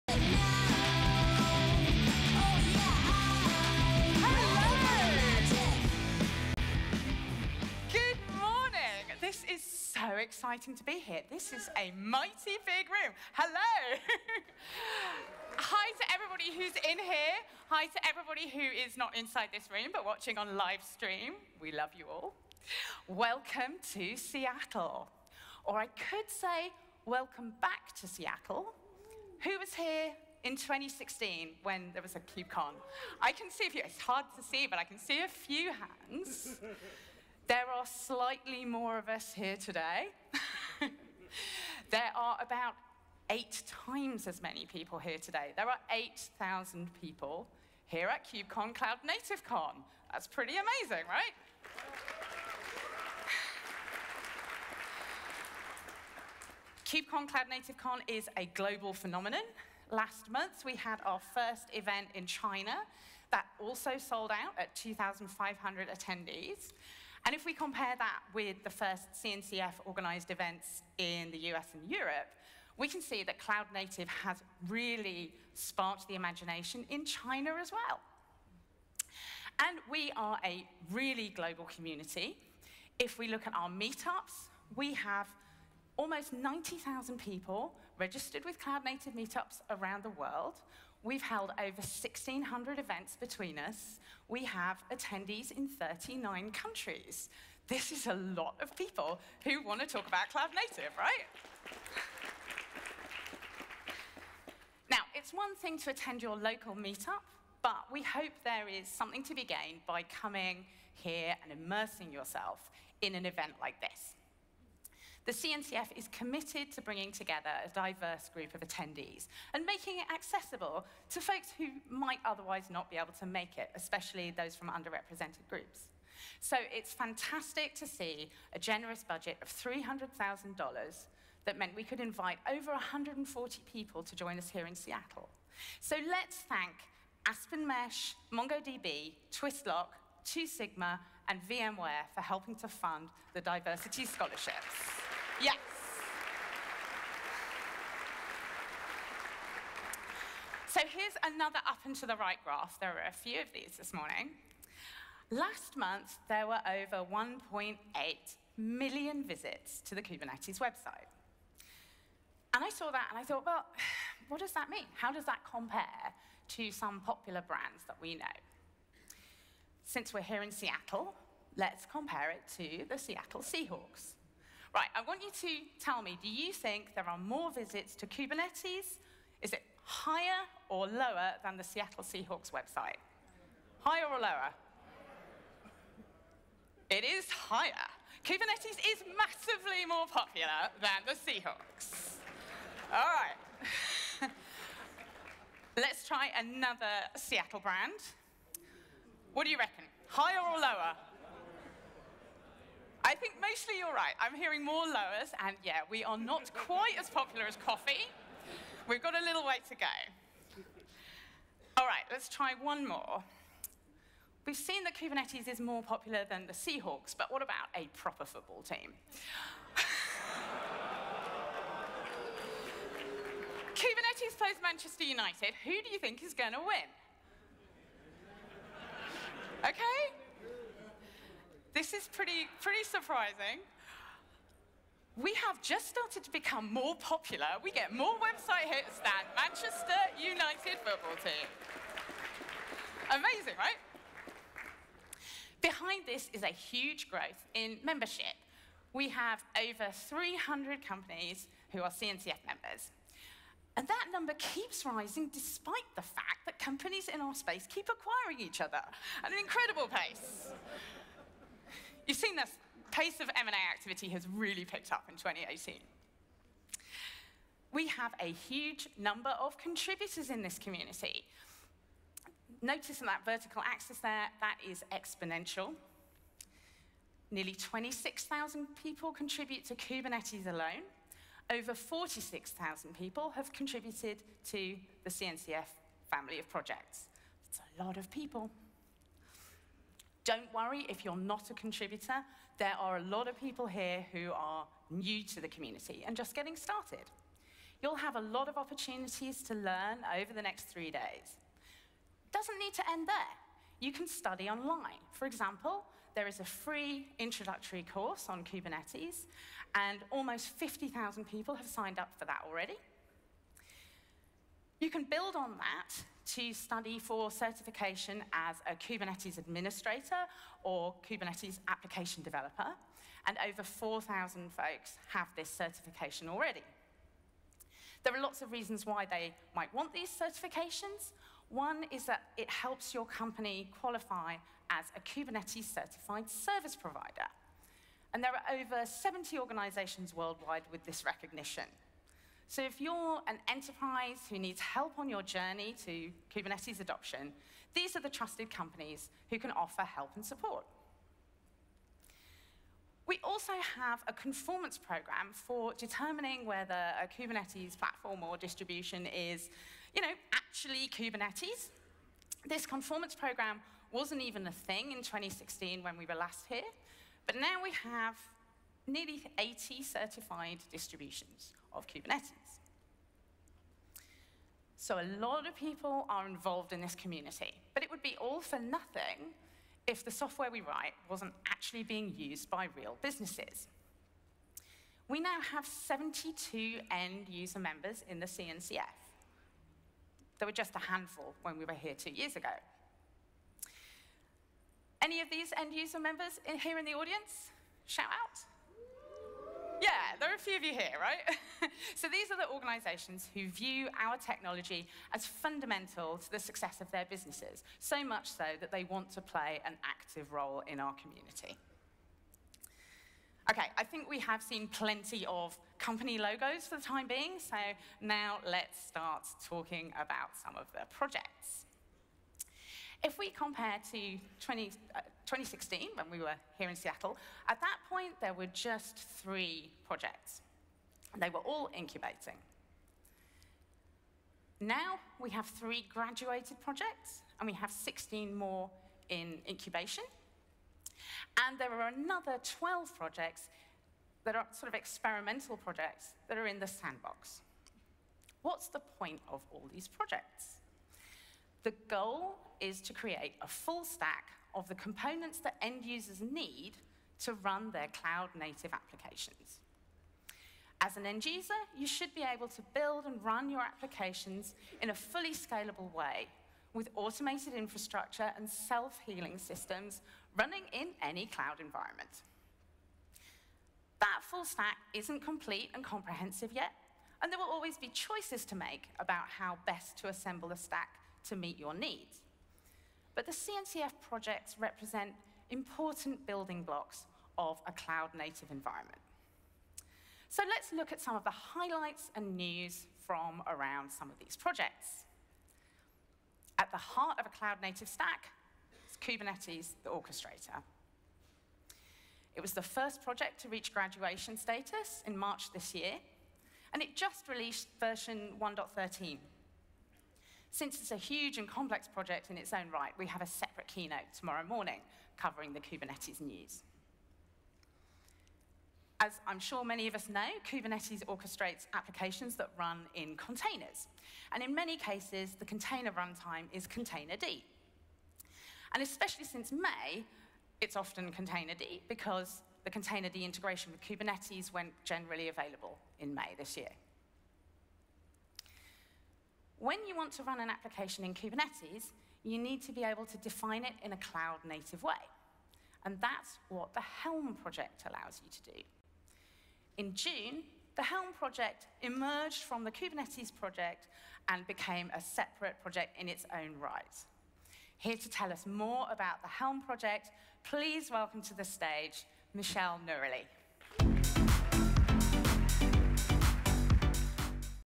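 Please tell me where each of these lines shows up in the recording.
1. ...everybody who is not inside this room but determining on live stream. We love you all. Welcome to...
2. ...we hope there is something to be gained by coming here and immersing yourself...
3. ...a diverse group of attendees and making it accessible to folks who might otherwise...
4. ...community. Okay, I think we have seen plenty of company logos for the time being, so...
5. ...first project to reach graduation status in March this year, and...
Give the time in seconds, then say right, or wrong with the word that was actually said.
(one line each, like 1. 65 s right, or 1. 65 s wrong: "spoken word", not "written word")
1. 18 s wrong: "watching", not "determining"
2. 107 s right
3. 117 s right
4. 410 s right
5. 502 s right.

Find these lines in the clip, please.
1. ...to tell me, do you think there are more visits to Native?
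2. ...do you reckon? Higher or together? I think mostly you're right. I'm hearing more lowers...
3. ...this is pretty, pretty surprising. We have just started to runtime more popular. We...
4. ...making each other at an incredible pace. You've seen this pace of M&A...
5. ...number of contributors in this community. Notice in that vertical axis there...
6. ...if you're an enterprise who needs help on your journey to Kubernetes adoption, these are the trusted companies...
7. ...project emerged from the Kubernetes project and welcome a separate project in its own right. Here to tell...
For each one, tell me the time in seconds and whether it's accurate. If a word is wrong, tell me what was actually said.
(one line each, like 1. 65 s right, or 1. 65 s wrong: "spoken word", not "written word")
1. 175 s wrong: "Kubernetes", not "Native"
2. 199 s wrong: "lower", not "together"
3. 231 s wrong: "become", not "runtime"
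4. 257 s wrong: "acquiring", not "making"
5. 268 s right
6. 342 s right
7. 551 s wrong: "became", not "welcome".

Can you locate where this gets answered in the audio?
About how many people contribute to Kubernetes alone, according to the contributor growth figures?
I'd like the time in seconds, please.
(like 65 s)
277 s.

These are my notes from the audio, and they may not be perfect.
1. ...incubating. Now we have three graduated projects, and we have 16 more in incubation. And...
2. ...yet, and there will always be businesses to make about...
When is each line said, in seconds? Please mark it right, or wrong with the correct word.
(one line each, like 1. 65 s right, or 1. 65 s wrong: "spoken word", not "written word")
1. 431 s right
2. 476 s wrong: "choices", not "businesses".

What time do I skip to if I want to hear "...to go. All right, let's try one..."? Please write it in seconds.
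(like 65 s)
209 s.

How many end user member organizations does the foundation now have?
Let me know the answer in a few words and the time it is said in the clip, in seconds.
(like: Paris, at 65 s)
72, at 385 s.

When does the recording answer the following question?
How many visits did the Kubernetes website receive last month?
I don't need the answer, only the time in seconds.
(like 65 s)
157 s.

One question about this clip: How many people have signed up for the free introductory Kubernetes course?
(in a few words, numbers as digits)
50,000.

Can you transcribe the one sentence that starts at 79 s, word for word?
And we are a really global community.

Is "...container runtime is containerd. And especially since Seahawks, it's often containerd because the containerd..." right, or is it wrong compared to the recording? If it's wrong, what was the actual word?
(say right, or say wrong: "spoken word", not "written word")
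wrong: "May", not "Seahawks".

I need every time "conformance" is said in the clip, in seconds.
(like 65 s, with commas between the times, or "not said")
354 s, 362 s.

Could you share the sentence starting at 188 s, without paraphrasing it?
Kubernetes is massively more popular than the Seahawks.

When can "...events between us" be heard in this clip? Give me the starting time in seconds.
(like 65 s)
92 s.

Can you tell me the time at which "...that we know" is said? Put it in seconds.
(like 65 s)
167 s.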